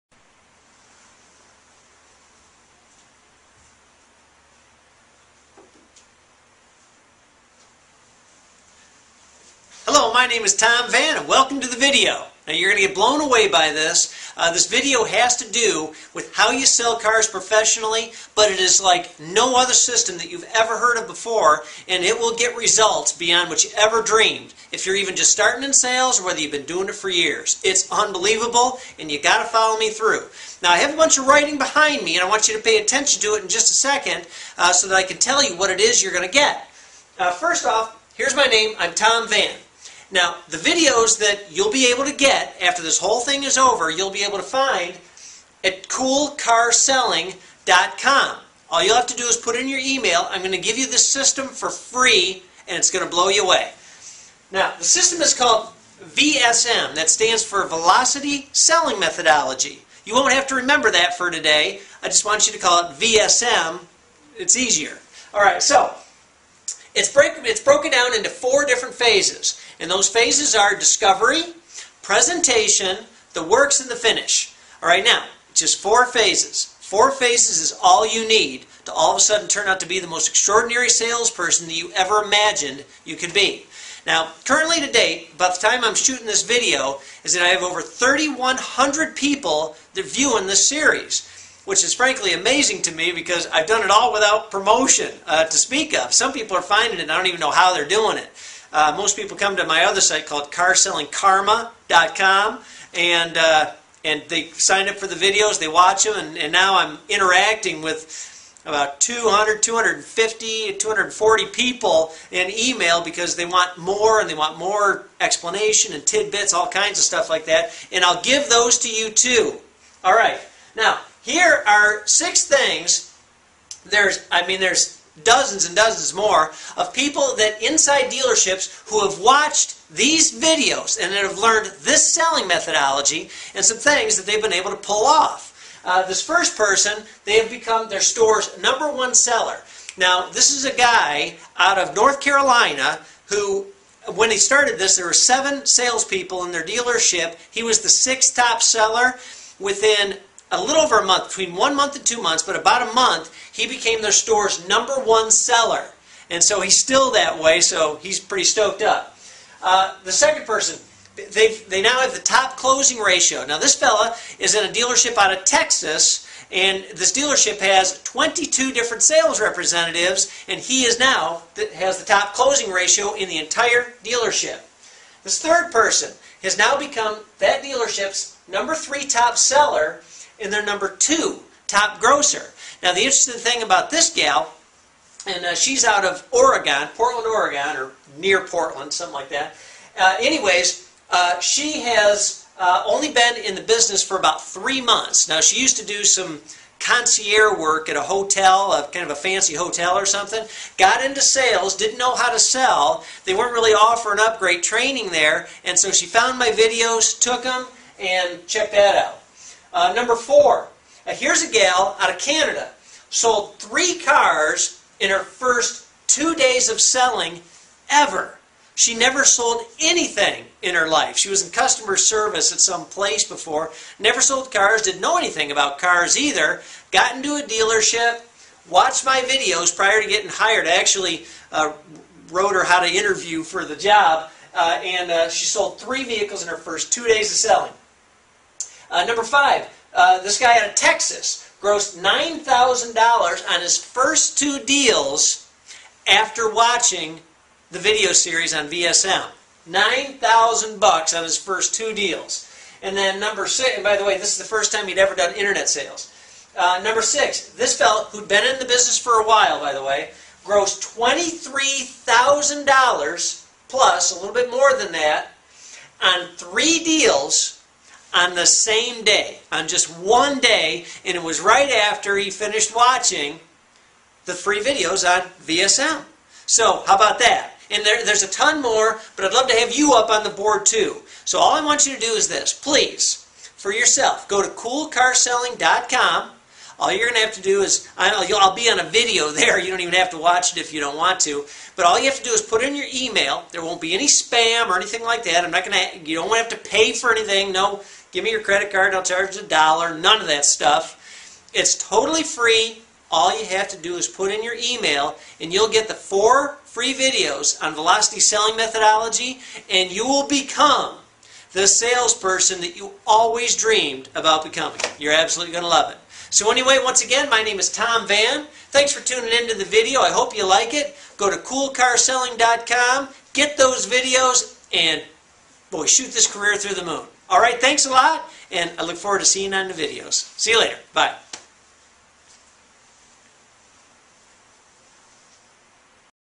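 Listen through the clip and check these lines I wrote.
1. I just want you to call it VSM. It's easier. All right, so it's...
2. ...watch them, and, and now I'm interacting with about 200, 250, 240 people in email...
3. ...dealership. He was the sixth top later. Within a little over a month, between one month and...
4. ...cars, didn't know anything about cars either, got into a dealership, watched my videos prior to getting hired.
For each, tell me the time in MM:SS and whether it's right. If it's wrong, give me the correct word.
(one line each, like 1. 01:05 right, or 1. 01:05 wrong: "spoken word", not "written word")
1. 01:02 right
2. 01:45 right
3. 02:26 wrong: "seller", not "later"
4. 03:44 right.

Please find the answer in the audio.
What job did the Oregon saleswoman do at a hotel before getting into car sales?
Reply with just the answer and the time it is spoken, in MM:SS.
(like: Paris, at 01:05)
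concierge work, at 03:16.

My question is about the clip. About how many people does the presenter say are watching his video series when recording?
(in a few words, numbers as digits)
3,100.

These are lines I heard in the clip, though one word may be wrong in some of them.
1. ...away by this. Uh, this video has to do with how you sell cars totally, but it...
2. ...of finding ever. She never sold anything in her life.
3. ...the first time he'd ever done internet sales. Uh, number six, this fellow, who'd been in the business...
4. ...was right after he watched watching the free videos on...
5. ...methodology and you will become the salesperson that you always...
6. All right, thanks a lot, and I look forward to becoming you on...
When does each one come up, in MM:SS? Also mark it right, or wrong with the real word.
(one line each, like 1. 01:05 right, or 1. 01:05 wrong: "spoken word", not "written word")
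1. 00:13 wrong: "professionally", not "totally"
2. 03:36 wrong: "selling", not "finding"
3. 04:14 right
4. 04:31 wrong: "finished", not "watched"
5. 05:08 right
6. 05:27 wrong: "seeing", not "becoming".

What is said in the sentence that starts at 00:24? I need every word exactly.
If you're even just starting in sales or whether you've been doing it for years.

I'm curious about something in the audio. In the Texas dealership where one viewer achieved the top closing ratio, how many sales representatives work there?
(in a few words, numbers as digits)
22.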